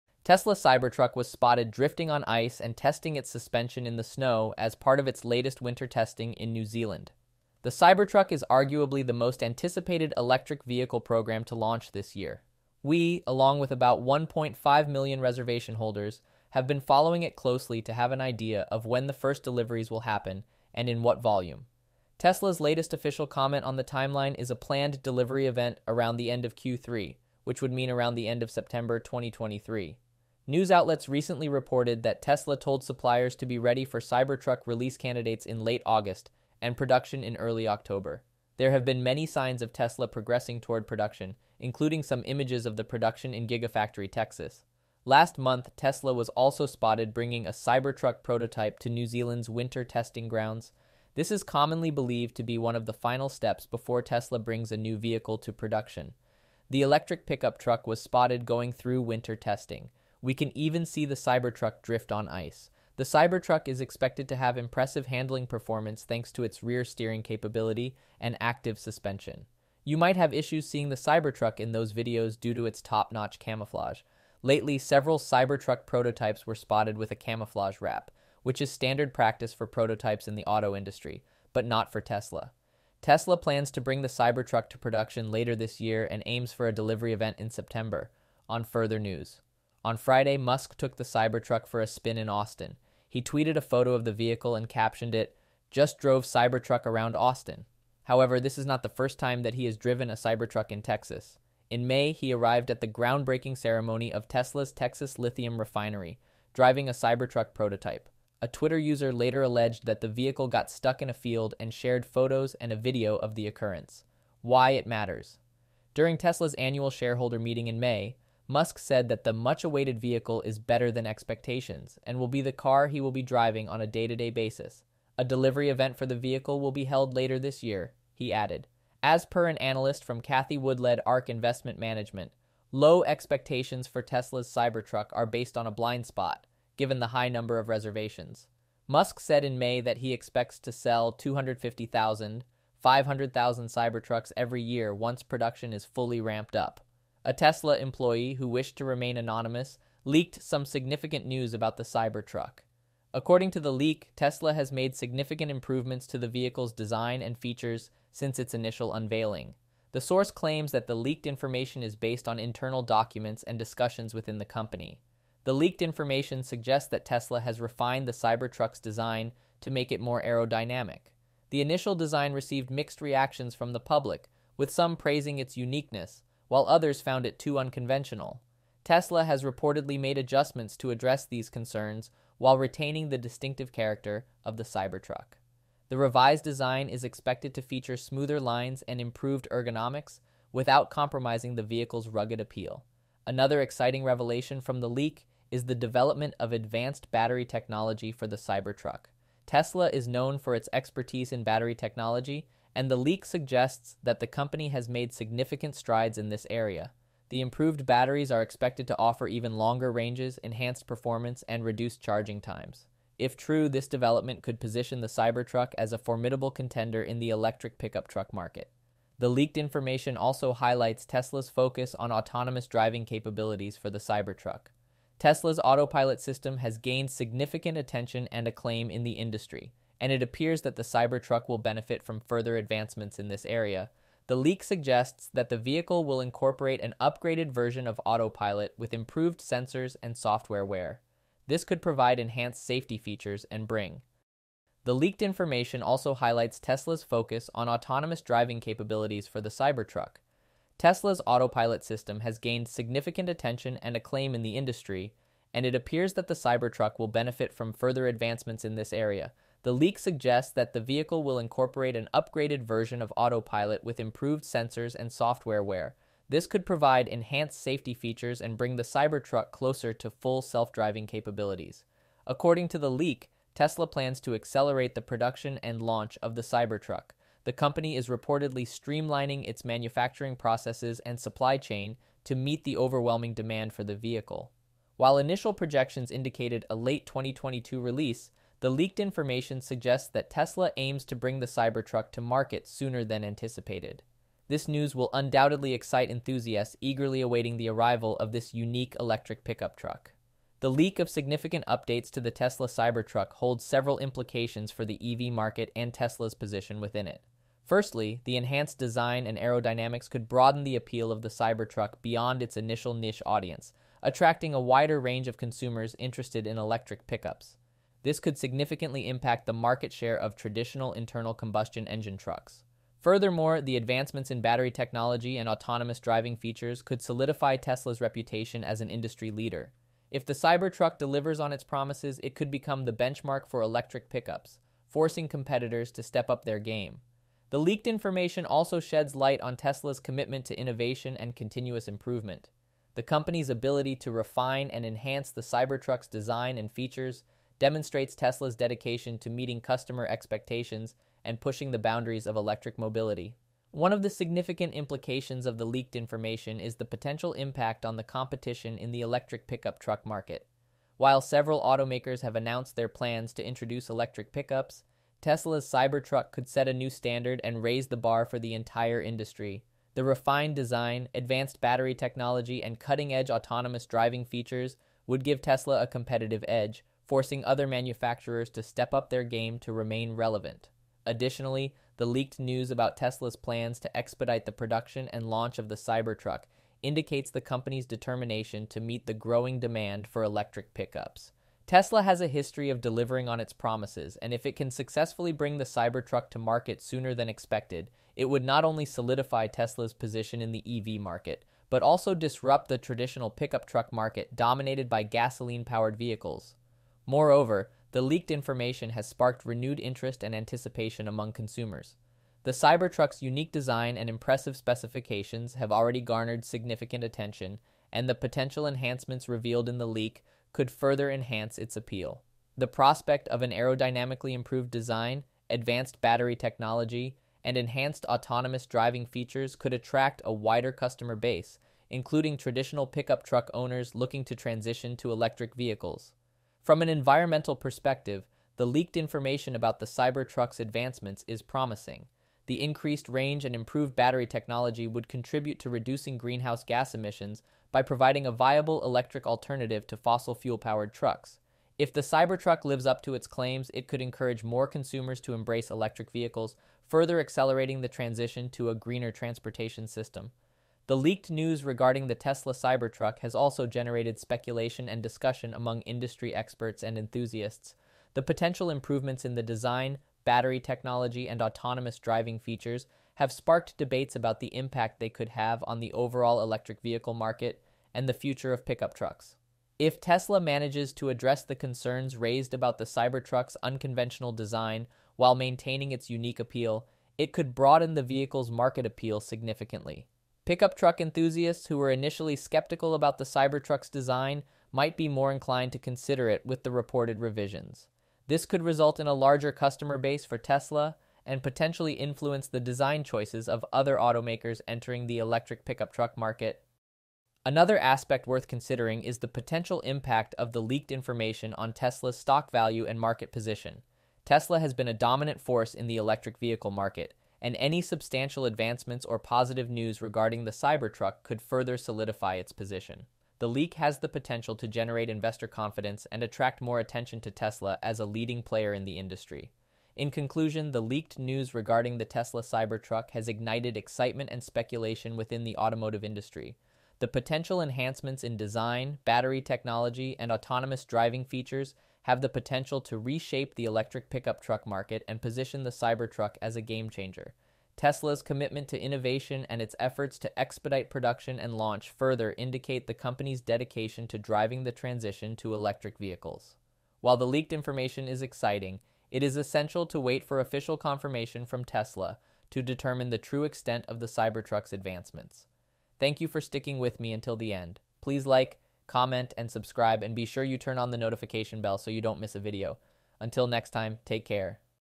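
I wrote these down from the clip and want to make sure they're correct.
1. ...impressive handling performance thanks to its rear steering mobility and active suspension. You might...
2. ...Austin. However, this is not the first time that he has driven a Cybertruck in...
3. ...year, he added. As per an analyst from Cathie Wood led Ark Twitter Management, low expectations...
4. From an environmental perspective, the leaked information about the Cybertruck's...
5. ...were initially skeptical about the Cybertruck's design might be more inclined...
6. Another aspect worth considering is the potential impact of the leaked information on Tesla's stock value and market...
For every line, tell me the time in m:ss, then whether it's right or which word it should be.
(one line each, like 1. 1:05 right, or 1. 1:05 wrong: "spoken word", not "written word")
1. 1:04 wrong: "capability", not "mobility"
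2. 1:37 right
3. 2:07 wrong: "Investment", not "Twitter"
4. 7:16 right
5. 8:11 right
6. 8:27 right.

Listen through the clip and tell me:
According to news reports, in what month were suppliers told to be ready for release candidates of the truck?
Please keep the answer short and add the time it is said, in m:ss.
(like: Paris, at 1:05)
August, at 0:35.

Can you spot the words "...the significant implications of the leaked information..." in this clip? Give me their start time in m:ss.
5:54.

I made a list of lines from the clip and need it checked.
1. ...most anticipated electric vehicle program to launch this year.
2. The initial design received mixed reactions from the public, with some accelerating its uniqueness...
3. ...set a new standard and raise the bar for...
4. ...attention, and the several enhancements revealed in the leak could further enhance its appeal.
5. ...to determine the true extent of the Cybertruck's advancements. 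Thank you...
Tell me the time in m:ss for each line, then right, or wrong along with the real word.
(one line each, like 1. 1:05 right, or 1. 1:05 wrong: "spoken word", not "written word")
1. 0:09 right
2. 2:51 wrong: "praising", not "accelerating"
3. 6:06 right
4. 6:57 wrong: "potential", not "several"
5. 9:22 right.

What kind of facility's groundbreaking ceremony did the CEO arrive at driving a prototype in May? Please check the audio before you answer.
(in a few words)
Lithium refinery.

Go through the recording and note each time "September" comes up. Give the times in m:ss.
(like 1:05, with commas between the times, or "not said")
0:28, 1:27.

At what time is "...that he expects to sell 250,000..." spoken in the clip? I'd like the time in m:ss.
2:19.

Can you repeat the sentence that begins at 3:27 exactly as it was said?
The improved batteries are expected to offer even longer ranges, enhanced performance, and reduced charging times.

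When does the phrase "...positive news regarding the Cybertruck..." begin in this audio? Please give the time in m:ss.
8:39.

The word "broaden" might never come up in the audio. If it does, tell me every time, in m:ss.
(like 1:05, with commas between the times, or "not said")
5:10, 8:07.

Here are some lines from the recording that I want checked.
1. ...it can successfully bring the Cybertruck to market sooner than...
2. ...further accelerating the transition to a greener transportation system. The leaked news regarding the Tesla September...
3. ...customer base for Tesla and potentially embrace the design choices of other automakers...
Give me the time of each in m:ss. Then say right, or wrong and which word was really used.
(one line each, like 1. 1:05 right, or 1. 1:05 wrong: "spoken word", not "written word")
1. 6:34 right
2. 7:36 wrong: "Cybertruck", not "September"
3. 8:19 wrong: "influence", not "embrace".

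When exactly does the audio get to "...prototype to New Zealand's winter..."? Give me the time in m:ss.
0:48.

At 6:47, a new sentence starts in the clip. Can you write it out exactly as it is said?
Moreover, the leaked information has sparked renewed interest and anticipation among consumers.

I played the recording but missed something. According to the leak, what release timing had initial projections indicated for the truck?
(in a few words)
Late 2022.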